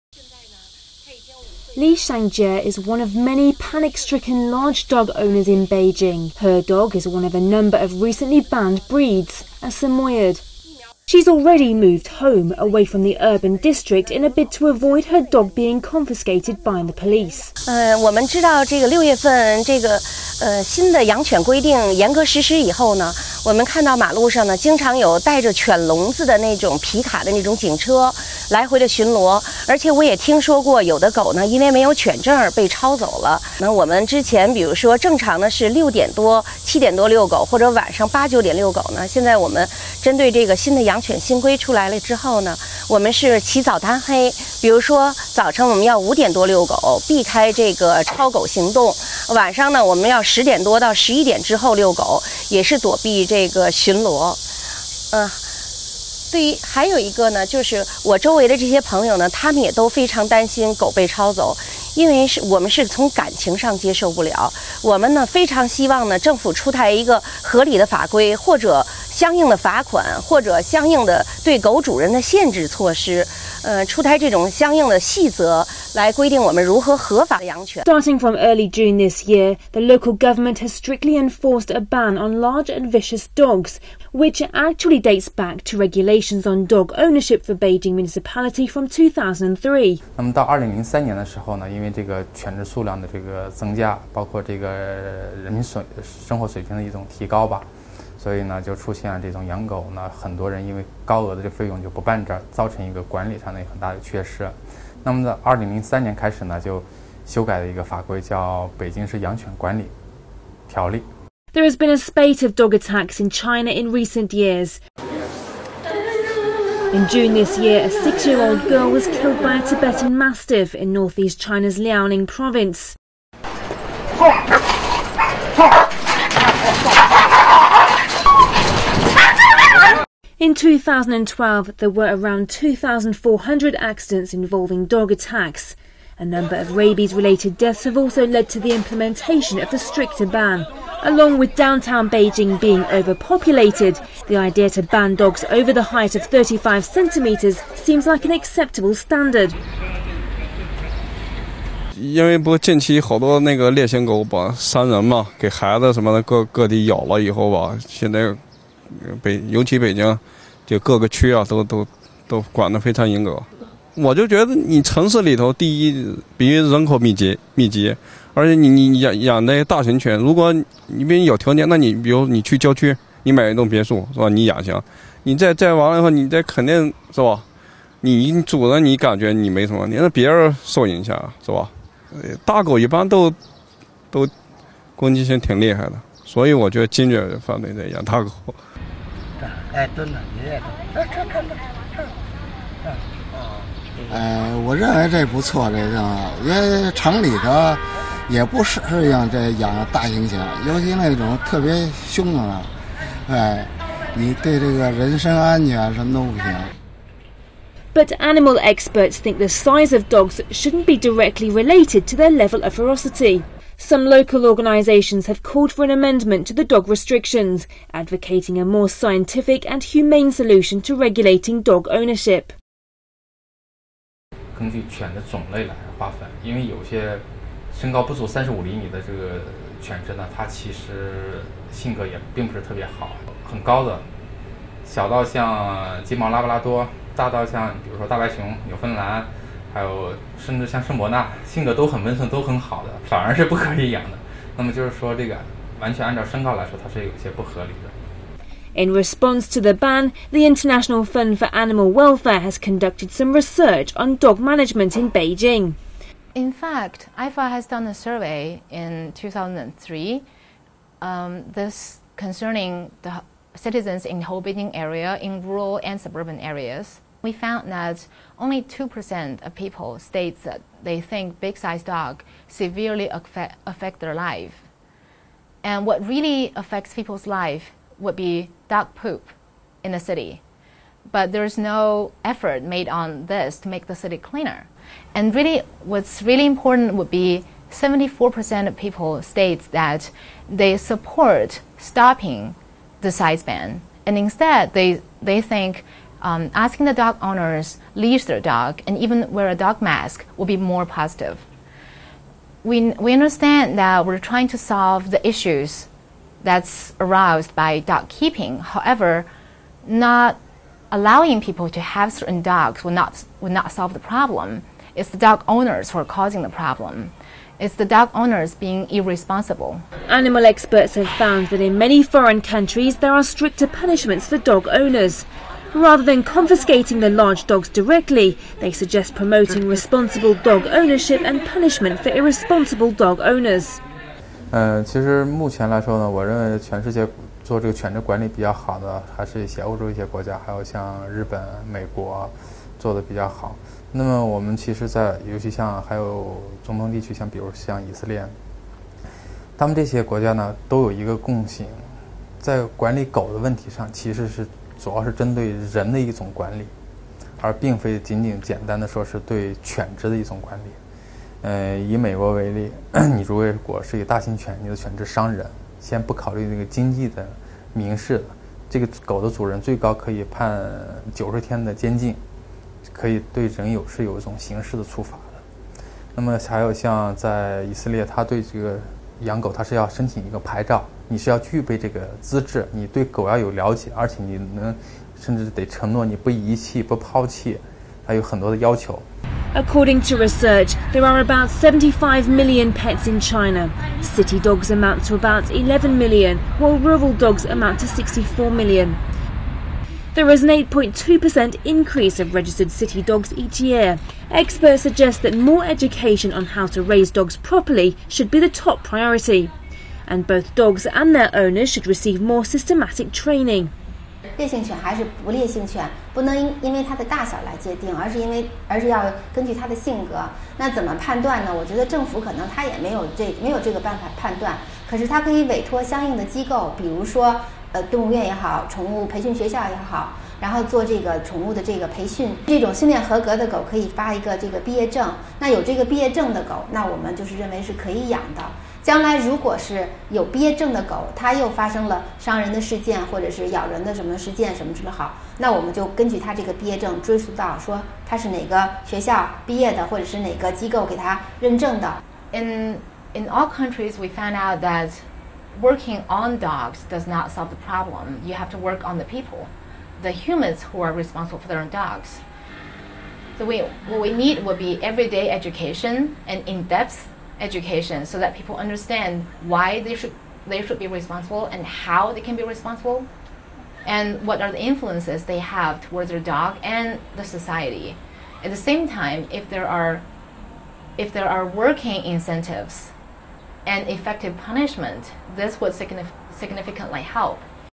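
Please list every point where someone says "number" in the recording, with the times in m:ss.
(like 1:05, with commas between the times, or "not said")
0:07, 2:16.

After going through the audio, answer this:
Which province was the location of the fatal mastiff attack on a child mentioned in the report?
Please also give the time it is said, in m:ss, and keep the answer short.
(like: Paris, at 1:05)
Liaoning, at 2:01.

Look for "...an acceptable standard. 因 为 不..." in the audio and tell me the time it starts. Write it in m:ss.
2:28.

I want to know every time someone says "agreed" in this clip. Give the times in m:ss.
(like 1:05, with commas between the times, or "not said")
not said.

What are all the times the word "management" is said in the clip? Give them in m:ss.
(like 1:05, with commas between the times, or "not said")
4:14.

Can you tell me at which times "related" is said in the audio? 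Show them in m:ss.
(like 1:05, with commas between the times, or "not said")
2:17, 3:31.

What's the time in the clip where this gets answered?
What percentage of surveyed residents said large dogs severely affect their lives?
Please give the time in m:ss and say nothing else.
4:28.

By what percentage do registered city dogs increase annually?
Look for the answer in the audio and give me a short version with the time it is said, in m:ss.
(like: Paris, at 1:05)
8.2%, at 6:40.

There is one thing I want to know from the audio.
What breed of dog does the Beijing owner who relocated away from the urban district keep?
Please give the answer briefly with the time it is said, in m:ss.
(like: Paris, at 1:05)
Samoyed, at 0:09.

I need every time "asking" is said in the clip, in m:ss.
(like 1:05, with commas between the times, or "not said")
4:56.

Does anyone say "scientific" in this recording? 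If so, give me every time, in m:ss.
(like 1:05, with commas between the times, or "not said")
3:38.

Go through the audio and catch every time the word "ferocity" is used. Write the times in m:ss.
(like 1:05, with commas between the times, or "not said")
3:32.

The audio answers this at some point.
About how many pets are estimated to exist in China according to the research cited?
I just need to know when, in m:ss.
6:31.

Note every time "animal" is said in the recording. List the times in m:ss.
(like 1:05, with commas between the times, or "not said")
3:28, 4:11, 5:20.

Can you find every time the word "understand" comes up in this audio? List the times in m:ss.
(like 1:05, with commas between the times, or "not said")
5:03, 7:48.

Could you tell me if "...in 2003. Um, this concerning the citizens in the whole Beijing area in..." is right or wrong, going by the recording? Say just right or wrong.
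right.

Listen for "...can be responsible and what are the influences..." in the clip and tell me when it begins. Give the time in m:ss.
7:52.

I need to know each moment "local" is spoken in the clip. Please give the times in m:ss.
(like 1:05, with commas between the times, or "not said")
1:19, 3:34.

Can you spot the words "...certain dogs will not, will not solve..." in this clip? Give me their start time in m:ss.
5:12.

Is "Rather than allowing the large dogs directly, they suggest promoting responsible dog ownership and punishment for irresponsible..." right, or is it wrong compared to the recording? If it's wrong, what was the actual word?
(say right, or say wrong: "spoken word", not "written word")
wrong: "confiscating", not "allowing".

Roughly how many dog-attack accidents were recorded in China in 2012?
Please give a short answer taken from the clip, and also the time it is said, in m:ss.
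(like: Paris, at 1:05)
2,400, at 2:12.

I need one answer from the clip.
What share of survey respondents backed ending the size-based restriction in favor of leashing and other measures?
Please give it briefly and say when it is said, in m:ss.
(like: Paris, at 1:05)
74%, at 4:47.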